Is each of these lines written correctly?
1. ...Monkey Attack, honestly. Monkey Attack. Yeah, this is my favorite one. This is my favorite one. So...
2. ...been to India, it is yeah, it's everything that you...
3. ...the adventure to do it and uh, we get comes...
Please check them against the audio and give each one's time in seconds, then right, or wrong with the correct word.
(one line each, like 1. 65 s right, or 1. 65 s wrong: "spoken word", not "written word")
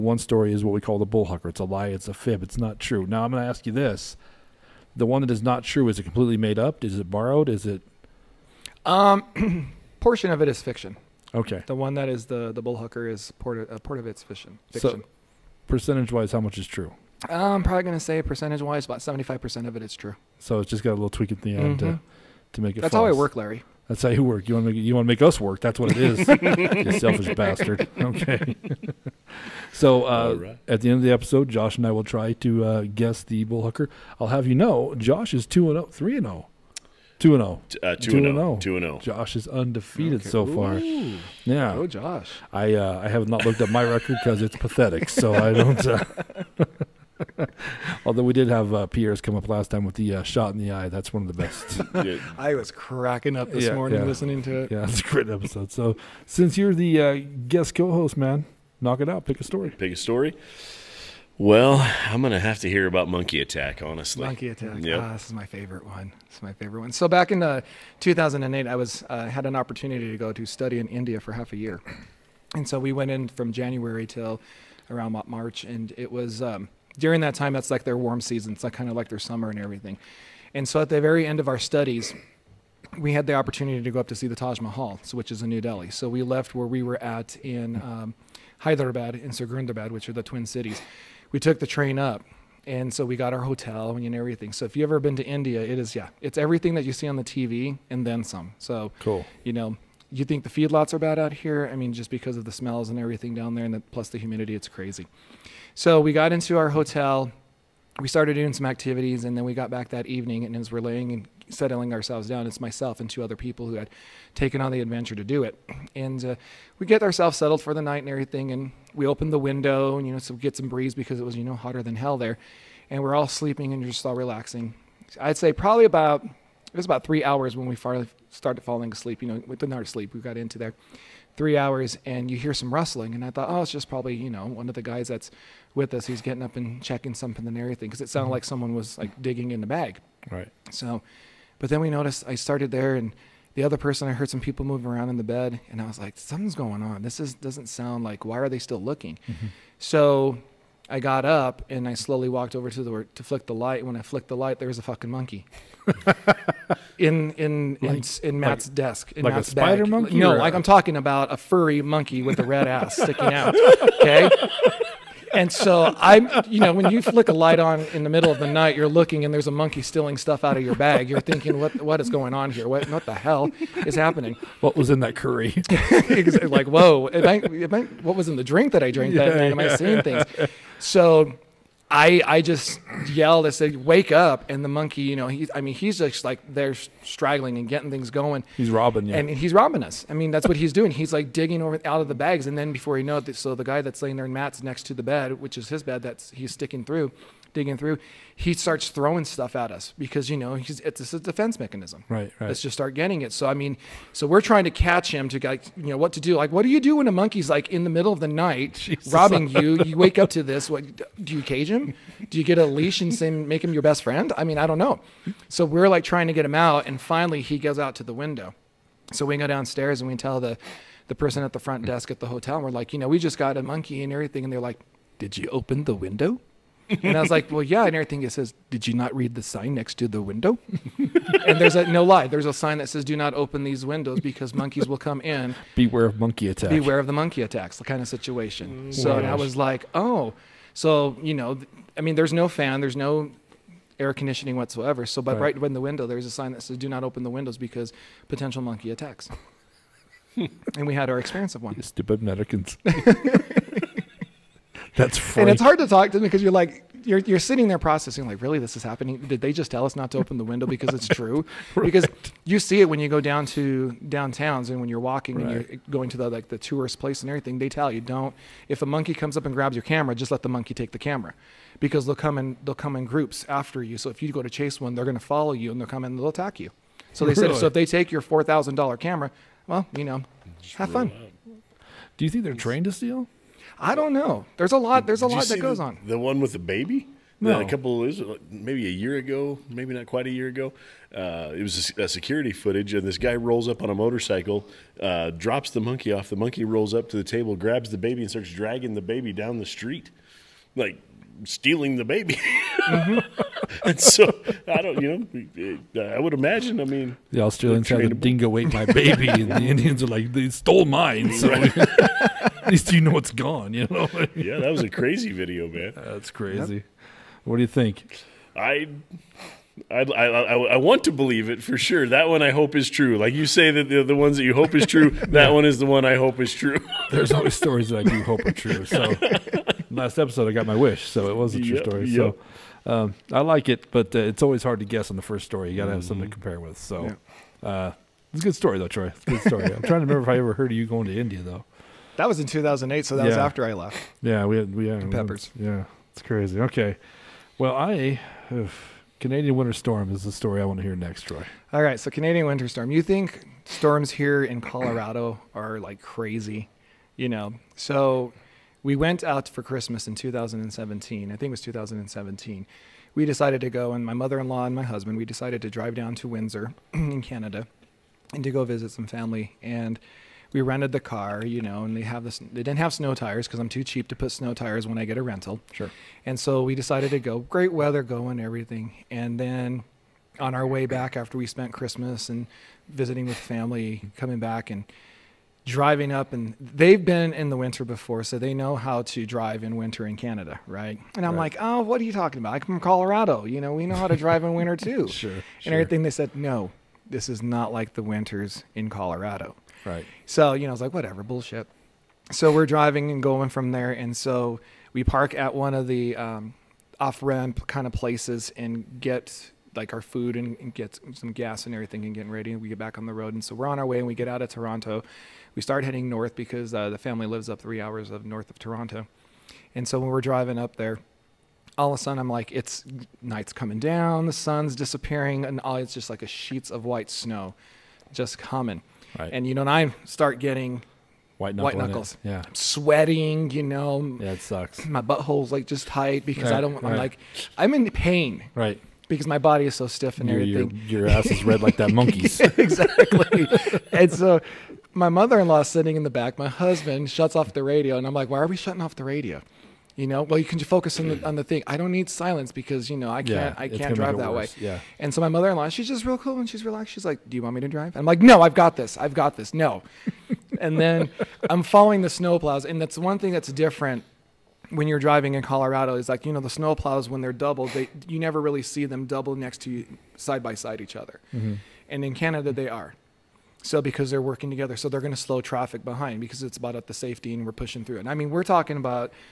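1. 63 s right
2. 94 s right
3. 114 s wrong: "ourselves", not "comes".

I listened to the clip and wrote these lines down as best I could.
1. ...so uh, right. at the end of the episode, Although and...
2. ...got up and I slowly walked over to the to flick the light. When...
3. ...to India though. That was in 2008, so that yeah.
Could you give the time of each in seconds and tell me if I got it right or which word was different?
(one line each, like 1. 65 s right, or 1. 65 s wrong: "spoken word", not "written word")
1. 29 s wrong: "Josh", not "Although"
2. 150 s right
3. 341 s right.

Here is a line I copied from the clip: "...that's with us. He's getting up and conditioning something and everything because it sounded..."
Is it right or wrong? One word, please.
wrong.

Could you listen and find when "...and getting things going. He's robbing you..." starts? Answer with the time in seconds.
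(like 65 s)
187 s.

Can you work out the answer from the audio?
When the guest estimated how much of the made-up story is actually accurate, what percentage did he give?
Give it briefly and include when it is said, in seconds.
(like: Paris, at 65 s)
75 percent, at 19 s.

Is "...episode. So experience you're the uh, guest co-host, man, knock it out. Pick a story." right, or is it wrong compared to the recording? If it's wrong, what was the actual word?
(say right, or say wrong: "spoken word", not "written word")
wrong: "since", not "experience".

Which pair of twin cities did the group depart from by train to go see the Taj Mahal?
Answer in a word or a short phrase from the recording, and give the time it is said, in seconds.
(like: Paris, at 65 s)
Hyderabad and Secunderabad, at 88 s.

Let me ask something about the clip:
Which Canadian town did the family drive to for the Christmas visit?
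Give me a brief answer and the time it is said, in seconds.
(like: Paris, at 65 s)
Windsor, at 366 s.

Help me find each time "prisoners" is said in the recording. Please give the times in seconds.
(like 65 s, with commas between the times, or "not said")
not said.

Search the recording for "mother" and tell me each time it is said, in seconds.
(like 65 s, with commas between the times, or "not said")
364 s, 445 s, 455 s.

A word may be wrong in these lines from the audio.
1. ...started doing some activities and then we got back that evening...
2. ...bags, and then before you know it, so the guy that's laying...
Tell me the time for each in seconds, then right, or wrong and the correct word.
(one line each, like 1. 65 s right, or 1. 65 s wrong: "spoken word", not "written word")
1. 108 s right
2. 192 s right.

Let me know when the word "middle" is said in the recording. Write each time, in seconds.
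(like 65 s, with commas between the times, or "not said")
168 s, 207 s.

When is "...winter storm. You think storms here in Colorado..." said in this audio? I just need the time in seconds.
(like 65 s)
352 s.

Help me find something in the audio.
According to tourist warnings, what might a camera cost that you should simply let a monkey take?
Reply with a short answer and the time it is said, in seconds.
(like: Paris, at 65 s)
4,000 dollars, at 278 s.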